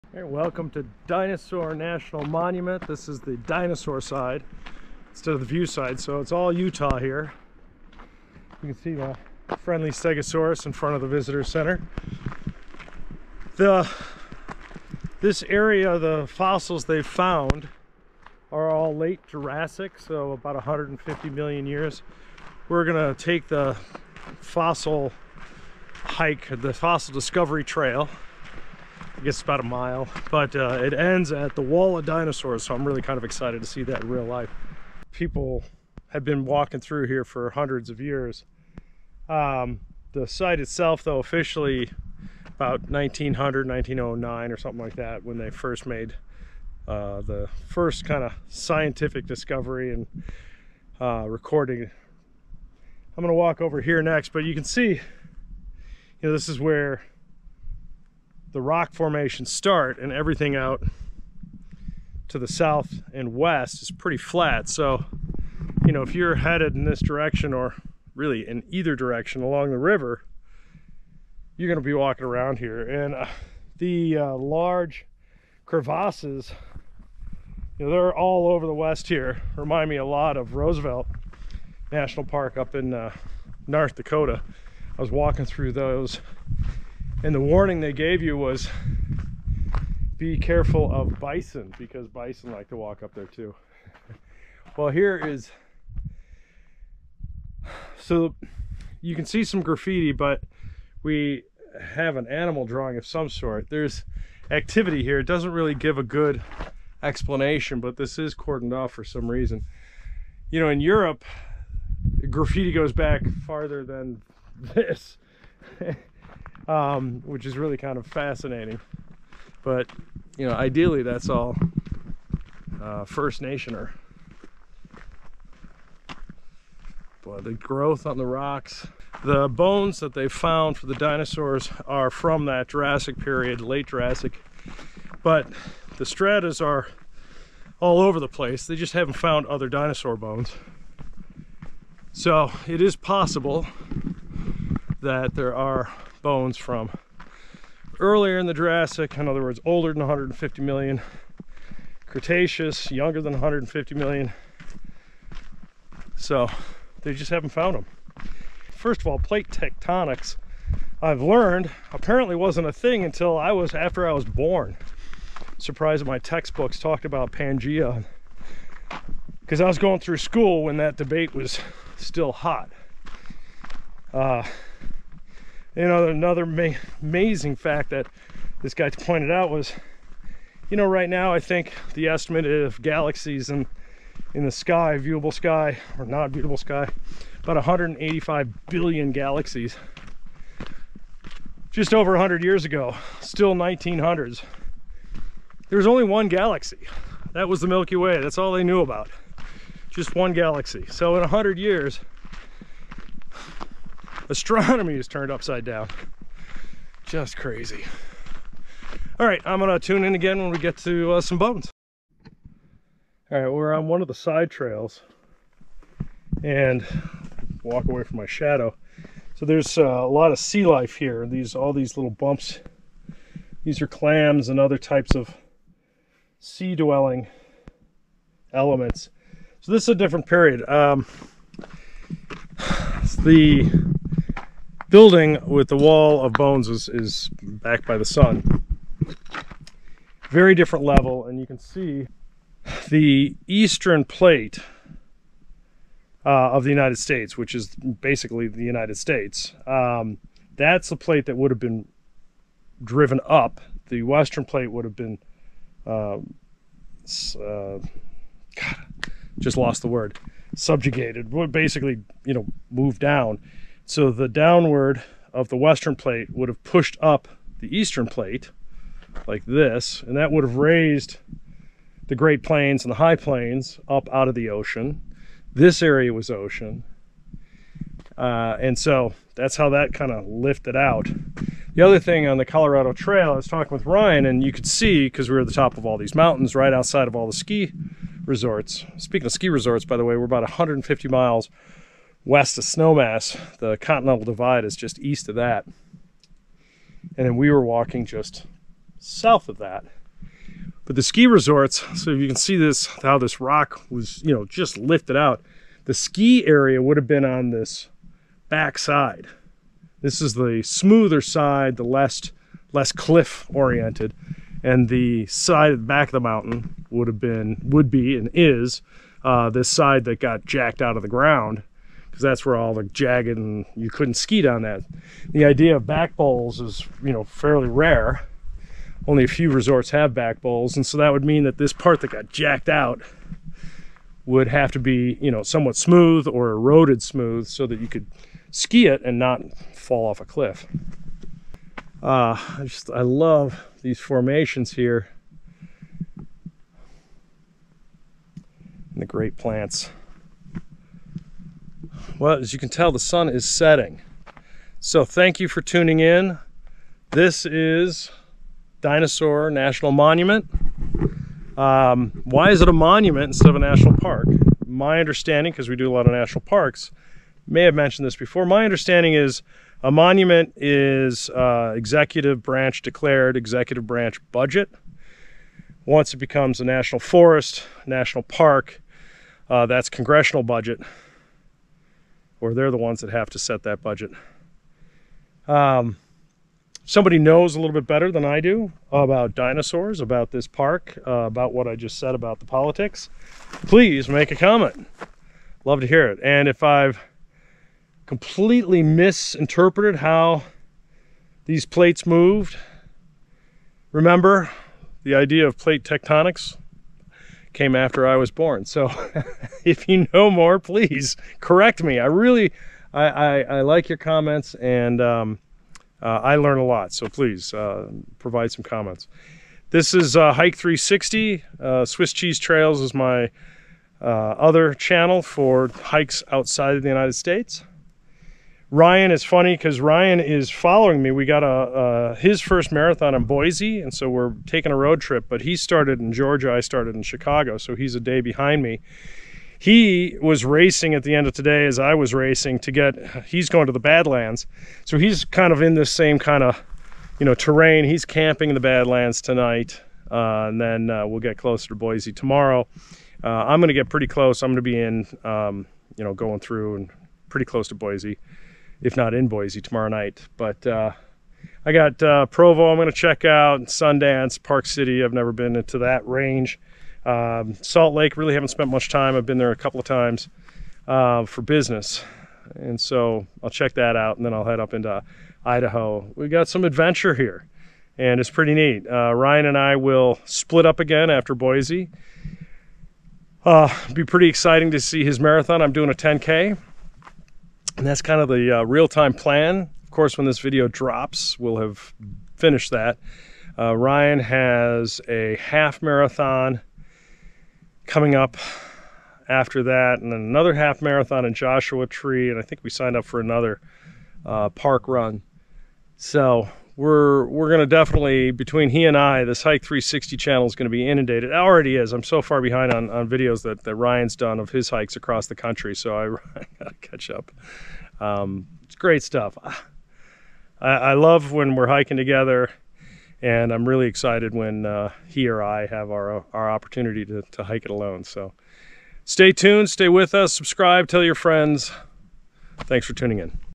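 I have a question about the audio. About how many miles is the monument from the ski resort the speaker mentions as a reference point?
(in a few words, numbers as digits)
150.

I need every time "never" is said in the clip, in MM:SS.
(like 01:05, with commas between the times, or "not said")
07:45.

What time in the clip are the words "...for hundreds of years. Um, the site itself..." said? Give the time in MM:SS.
00:37.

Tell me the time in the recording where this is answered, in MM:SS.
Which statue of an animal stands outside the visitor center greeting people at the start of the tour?
00:09.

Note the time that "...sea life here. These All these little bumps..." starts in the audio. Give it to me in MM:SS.
03:40.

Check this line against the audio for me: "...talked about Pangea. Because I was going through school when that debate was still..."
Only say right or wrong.
right.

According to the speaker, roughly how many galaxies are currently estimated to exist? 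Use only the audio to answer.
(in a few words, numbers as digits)
185 billion.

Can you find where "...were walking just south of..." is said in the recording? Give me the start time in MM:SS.
04:57.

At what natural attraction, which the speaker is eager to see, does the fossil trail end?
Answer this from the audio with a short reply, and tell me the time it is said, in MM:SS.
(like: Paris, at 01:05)
Wall of Dinosaurs, at 00:31.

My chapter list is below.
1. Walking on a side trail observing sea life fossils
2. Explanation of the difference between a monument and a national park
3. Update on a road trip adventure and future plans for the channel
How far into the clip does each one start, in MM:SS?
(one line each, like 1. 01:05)
1. 03:30
2. 05:58
3. 06:57.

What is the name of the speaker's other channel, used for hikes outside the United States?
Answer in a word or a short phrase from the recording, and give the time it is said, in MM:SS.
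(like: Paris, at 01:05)
Swiss Cheese Trails, at 07:01.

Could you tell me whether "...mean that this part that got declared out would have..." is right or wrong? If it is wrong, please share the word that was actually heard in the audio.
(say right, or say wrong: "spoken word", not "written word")
wrong: "jacked", not "declared".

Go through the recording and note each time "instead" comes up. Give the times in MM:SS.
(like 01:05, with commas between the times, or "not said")
00:05, 06:03.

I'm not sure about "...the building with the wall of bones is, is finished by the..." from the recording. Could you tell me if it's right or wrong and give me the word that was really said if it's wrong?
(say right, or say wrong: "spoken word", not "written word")
wrong: "backed", not "finished".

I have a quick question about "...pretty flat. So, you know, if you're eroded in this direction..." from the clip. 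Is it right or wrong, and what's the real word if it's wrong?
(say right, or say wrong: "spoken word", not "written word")
wrong: "headed", not "eroded".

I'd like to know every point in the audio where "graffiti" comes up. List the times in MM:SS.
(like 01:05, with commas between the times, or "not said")
01:39, 01:52.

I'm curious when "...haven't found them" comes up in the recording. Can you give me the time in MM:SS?
02:37.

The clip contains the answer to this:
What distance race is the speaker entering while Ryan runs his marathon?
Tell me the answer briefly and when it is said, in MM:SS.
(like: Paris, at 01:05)
10K, at 08:05.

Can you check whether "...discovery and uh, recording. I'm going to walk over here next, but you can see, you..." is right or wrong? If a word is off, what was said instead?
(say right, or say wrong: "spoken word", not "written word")
right.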